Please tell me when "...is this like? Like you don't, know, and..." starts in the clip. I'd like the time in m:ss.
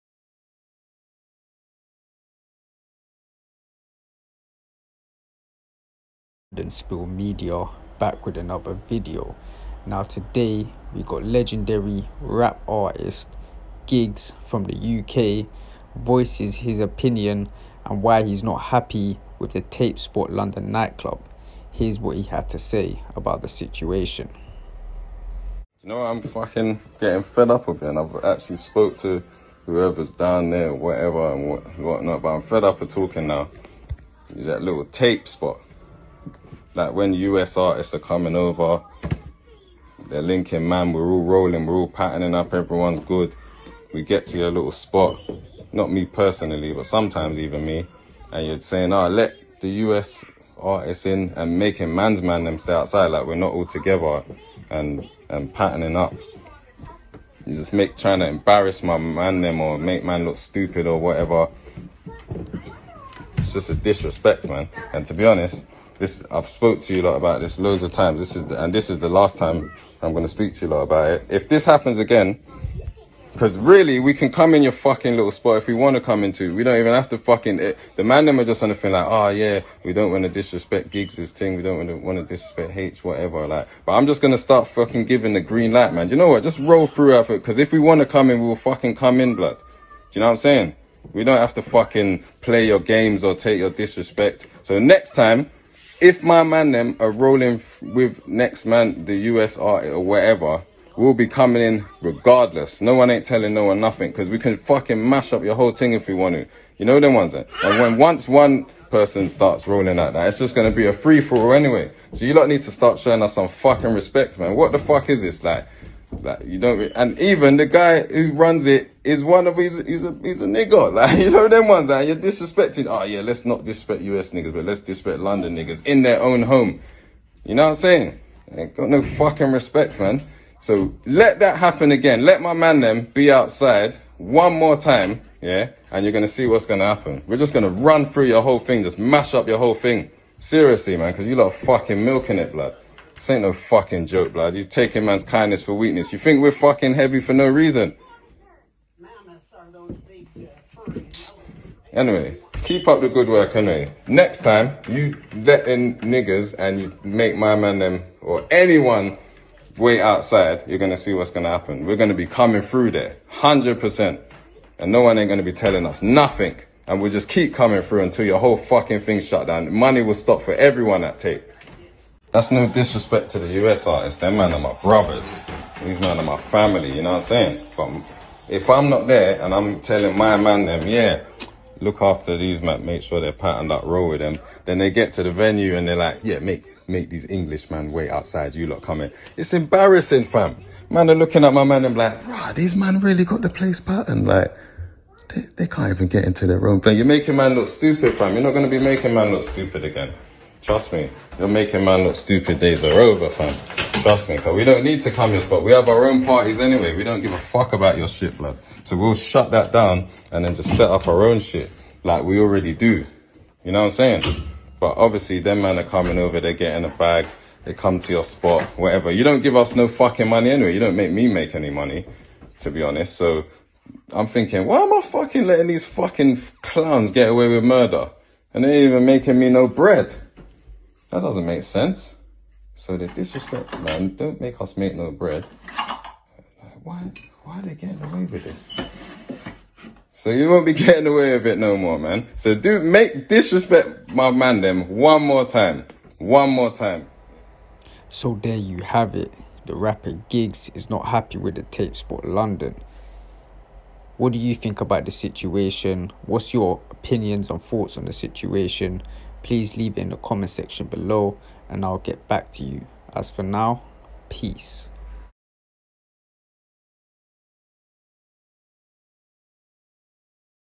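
1:55.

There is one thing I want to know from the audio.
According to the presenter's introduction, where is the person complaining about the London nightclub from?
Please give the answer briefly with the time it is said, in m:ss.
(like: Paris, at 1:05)
UK, at 0:14.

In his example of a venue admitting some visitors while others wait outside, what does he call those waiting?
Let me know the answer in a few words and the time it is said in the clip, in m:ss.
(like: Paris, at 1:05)
Englishmen, at 3:07.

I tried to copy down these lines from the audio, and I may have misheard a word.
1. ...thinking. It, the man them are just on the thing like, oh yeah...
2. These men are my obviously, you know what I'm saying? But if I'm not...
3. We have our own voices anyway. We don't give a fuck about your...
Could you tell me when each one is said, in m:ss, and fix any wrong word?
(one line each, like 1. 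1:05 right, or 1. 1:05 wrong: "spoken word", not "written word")
1. 1:17 wrong: "fucking", not "thinking"
2. 2:55 wrong: "family", not "obviously"
3. 3:25 wrong: "parties", not "voices".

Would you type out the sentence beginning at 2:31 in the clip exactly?
Anyway, keep up the good work anyway.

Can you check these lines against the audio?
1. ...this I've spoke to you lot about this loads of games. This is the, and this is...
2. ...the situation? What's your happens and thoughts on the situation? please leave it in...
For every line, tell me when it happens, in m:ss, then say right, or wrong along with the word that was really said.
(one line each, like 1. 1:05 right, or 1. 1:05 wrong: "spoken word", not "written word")
1. 1:06 wrong: "times", not "games"
2. 4:15 wrong: "opinions", not "happens".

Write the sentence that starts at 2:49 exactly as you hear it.
Money will stop for everyone at tape.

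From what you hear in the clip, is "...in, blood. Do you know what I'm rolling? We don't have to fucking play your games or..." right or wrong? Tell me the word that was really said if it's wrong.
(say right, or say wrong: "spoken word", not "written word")
wrong: "saying", not "rolling".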